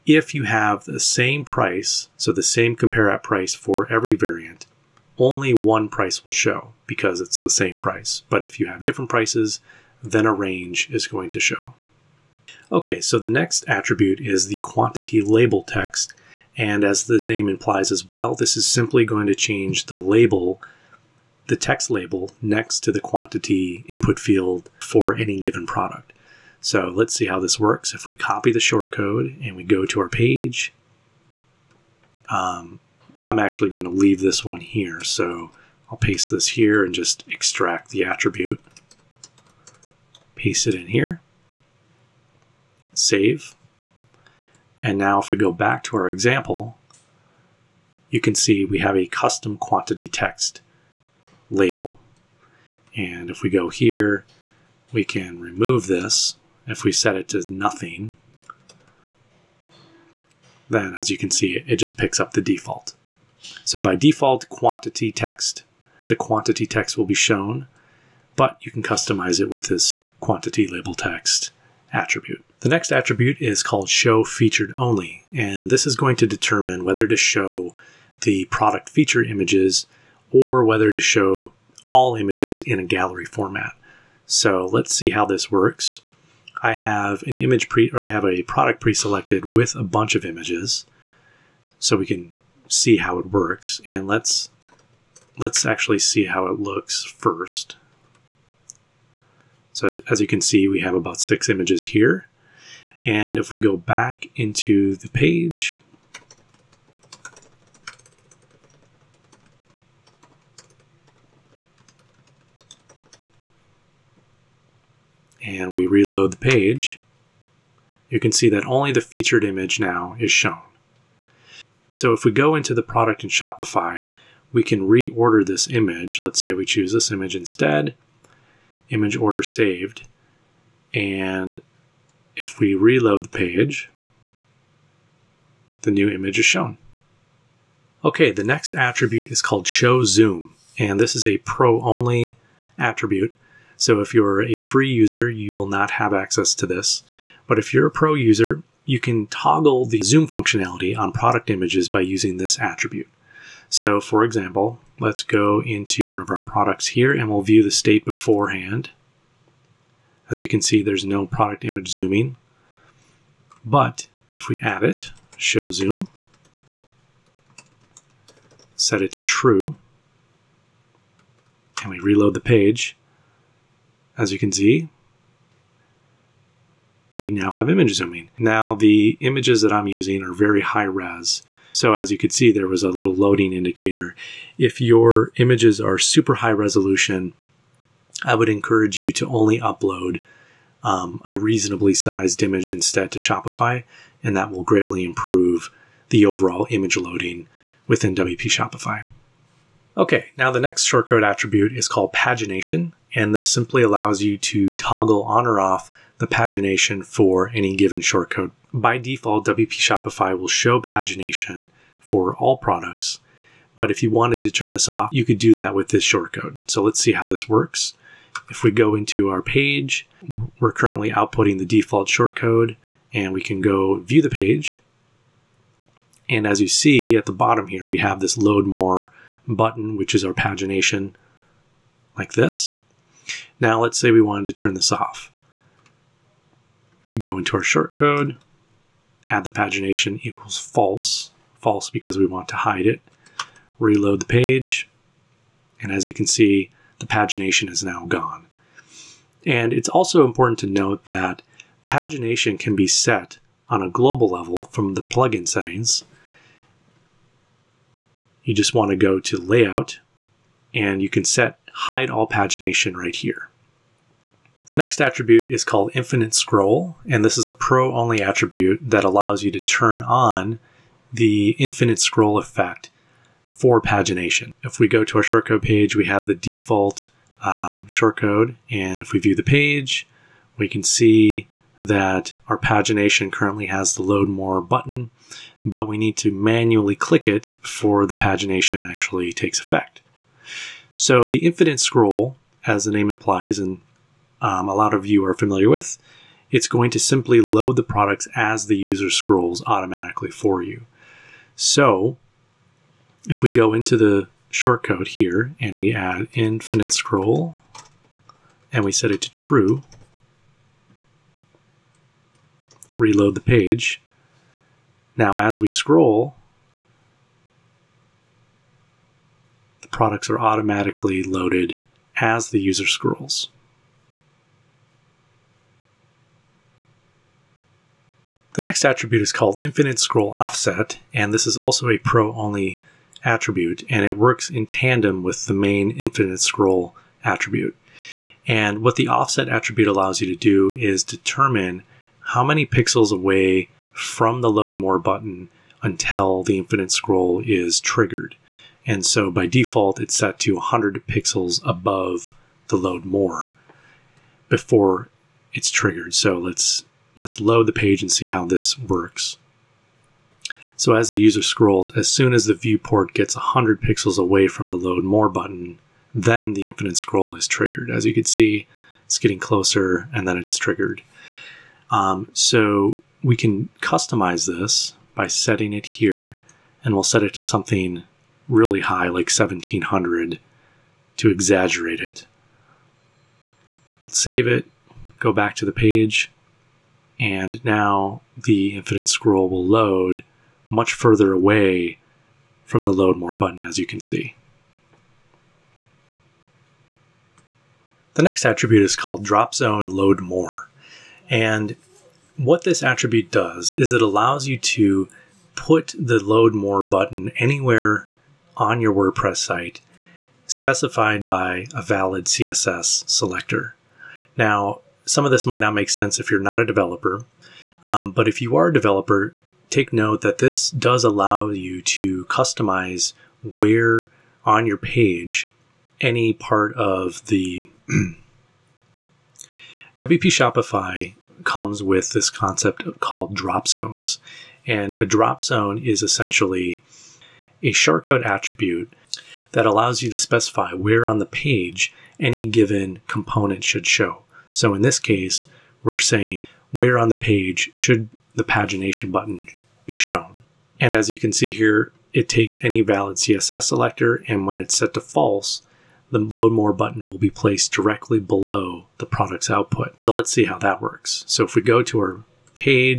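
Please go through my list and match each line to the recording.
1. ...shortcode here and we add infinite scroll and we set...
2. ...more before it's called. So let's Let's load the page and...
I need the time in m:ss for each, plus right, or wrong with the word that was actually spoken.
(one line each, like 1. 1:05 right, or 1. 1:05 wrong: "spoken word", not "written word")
1. 5:04 right
2. 5:53 wrong: "triggered", not "called".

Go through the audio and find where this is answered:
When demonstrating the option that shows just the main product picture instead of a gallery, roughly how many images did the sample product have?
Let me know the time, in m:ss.
1:41.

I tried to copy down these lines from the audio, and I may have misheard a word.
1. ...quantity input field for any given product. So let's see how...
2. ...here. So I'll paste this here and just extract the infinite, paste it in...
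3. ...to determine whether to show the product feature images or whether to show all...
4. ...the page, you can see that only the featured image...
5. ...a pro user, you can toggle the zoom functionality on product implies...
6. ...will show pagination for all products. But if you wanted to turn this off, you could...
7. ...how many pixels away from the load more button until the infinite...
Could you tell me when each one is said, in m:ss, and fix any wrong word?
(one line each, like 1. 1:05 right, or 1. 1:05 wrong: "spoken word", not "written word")
1. 0:22 right
2. 0:34 wrong: "attribute", not "infinite"
3. 1:16 right
4. 1:56 right
5. 2:27 wrong: "images", not "implies"
6. 3:30 right
7. 5:42 right.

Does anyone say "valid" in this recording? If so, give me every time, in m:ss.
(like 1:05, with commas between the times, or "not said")
6:51, 7:32.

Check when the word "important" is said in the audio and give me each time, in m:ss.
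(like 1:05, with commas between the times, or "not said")
4:10.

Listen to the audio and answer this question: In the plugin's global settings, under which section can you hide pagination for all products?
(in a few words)
Layout.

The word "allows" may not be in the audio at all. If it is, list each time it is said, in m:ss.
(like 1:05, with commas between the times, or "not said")
3:23, 4:29, 5:39, 6:44, 7:01, 7:19.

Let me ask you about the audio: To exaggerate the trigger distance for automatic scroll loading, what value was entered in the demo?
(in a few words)
1700.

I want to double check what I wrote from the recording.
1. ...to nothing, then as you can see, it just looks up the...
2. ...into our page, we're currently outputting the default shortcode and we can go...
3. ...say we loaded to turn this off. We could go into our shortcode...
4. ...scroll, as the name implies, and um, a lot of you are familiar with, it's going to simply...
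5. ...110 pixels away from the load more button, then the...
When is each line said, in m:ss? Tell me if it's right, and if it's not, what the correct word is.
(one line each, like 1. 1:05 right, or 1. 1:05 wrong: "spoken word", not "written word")
1. 0:57 wrong: "picks", not "looks"
2. 3:38 right
3. 3:53 wrong: "wanted", not "loaded"
4. 4:51 right
5. 6:03 wrong: "100", not "110".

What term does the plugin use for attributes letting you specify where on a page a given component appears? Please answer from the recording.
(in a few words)
Drop zones.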